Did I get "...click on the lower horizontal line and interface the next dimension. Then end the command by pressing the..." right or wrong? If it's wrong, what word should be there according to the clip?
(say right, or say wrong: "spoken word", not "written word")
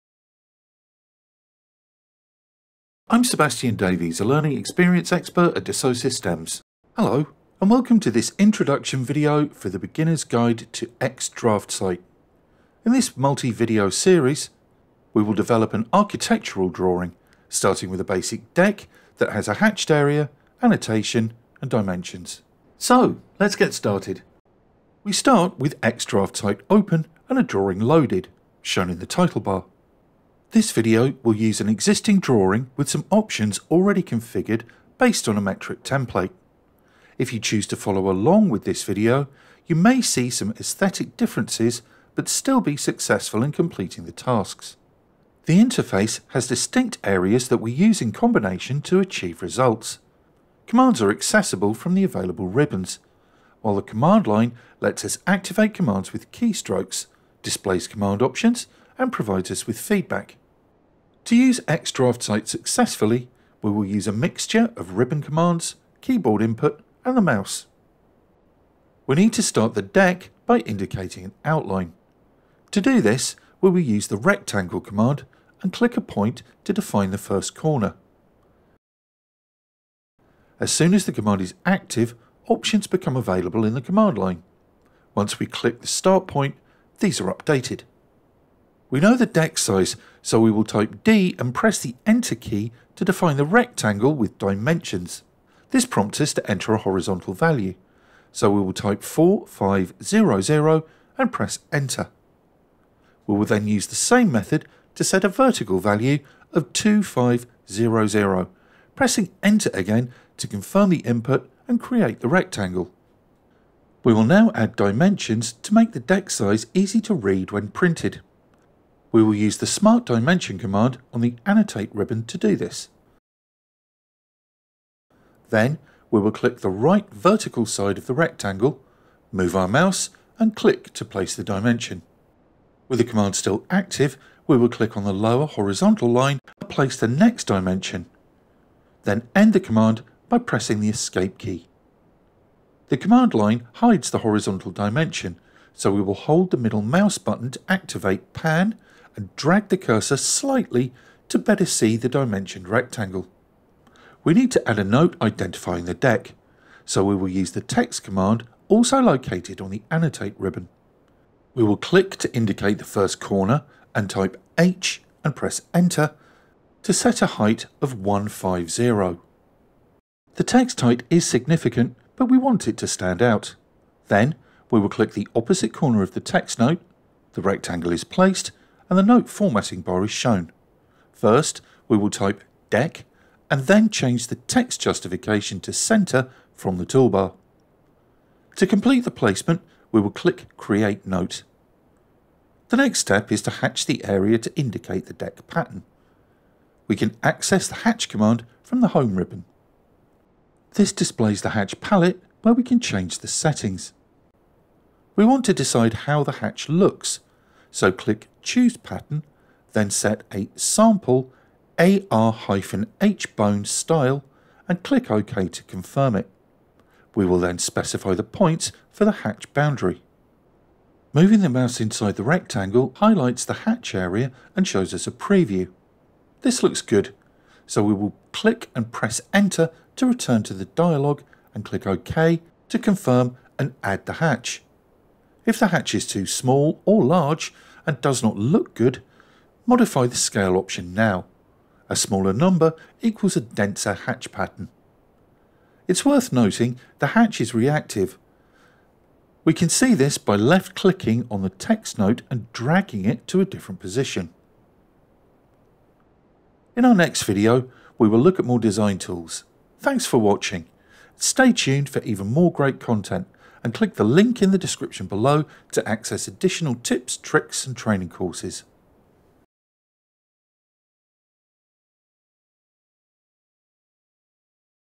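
wrong: "place", not "interface".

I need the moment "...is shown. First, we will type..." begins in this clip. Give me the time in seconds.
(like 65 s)
180 s.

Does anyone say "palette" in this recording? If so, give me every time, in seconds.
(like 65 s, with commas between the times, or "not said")
201 s.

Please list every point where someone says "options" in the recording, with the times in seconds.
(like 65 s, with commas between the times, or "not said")
33 s, 58 s, 82 s, 240 s.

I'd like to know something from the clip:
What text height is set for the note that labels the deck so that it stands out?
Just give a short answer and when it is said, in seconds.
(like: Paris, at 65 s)
150, at 167 s.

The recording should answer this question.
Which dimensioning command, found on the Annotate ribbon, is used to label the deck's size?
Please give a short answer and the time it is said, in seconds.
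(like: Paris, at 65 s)
Smart Dimension, at 119 s.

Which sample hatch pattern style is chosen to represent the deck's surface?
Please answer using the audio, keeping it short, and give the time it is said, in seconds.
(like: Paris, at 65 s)
AR-HBone, at 211 s.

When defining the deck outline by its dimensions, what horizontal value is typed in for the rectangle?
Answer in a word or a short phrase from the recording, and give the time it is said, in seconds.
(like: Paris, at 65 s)
4500, at 99 s.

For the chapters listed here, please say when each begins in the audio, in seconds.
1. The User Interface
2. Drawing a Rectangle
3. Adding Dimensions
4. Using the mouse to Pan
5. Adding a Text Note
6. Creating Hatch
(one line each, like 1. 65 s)
1. 24 s
2. 68 s
3. 113 s
4. 142 s
5. 153 s
6. 192 s.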